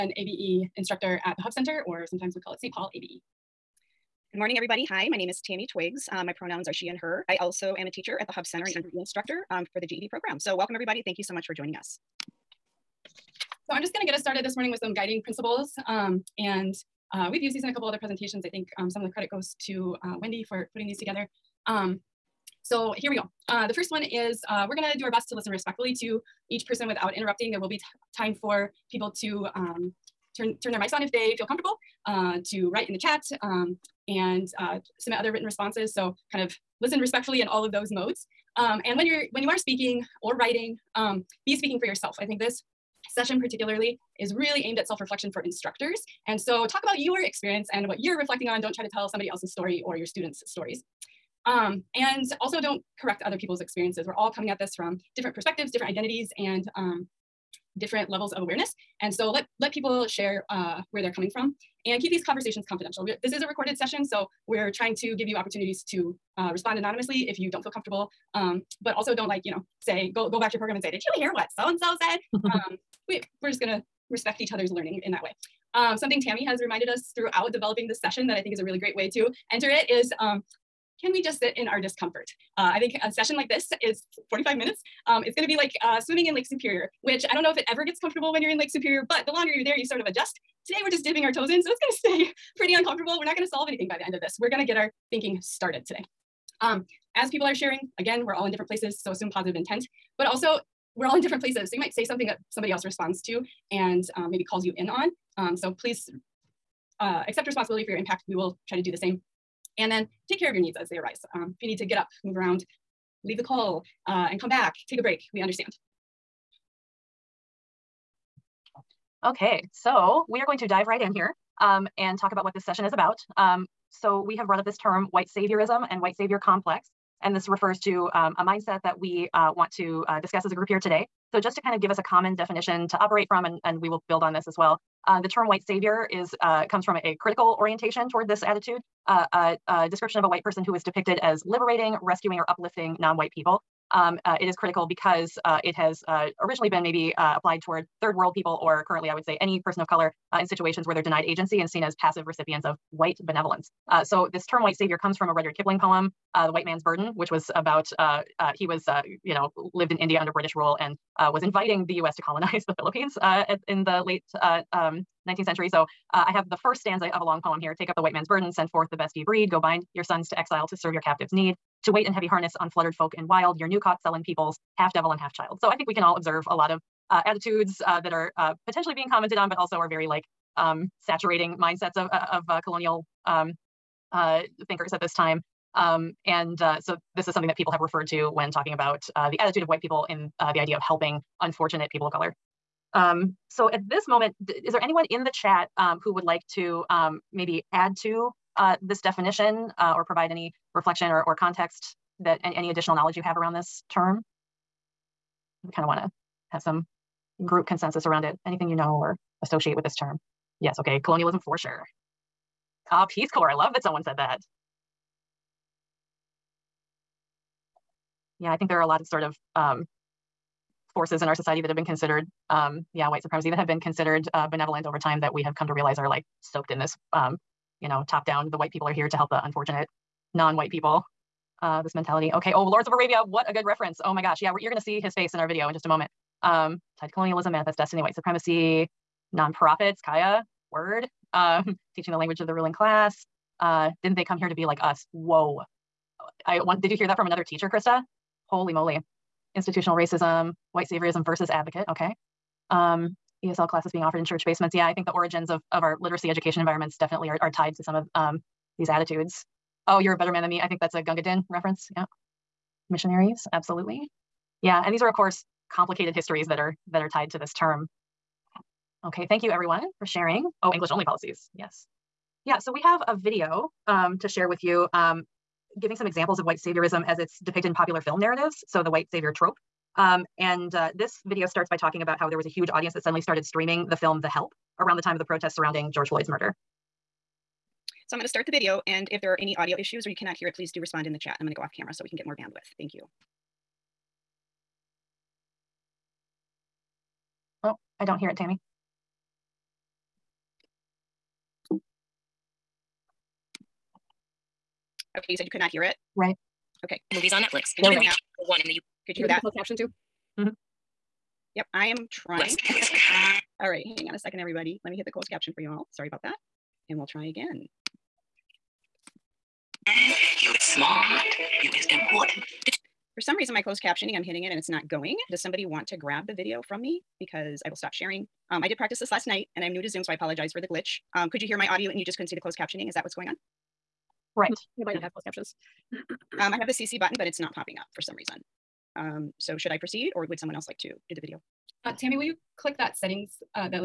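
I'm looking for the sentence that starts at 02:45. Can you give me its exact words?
So uh, I have the first stanza of a long poem here.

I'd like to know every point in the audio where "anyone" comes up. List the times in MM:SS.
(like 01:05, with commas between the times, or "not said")
03:14.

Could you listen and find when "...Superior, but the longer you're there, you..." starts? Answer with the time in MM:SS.
01:28.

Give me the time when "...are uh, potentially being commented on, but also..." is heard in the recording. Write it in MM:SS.
02:58.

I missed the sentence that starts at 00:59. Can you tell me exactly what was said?
And so let, let people share uh, where they're coming from and keep these conversations confidential.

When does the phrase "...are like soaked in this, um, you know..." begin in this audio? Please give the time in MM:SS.
03:45.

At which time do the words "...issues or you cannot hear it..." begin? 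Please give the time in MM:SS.
04:49.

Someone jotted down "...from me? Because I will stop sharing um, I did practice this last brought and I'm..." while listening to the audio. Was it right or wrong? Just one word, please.
wrong.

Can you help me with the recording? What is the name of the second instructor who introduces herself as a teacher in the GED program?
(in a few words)
Tammy Twiggs.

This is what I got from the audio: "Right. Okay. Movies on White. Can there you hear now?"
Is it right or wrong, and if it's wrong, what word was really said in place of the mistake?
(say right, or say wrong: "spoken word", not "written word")
wrong: "Netflix", not "White".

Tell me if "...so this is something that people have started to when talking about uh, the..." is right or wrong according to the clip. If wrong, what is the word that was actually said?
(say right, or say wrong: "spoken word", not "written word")
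wrong: "referred", not "started".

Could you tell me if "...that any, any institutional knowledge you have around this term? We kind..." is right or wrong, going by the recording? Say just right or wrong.
wrong.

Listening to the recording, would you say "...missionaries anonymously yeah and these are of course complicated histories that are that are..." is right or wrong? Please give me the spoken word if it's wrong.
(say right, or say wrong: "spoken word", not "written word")
wrong: "absolutely", not "anonymously".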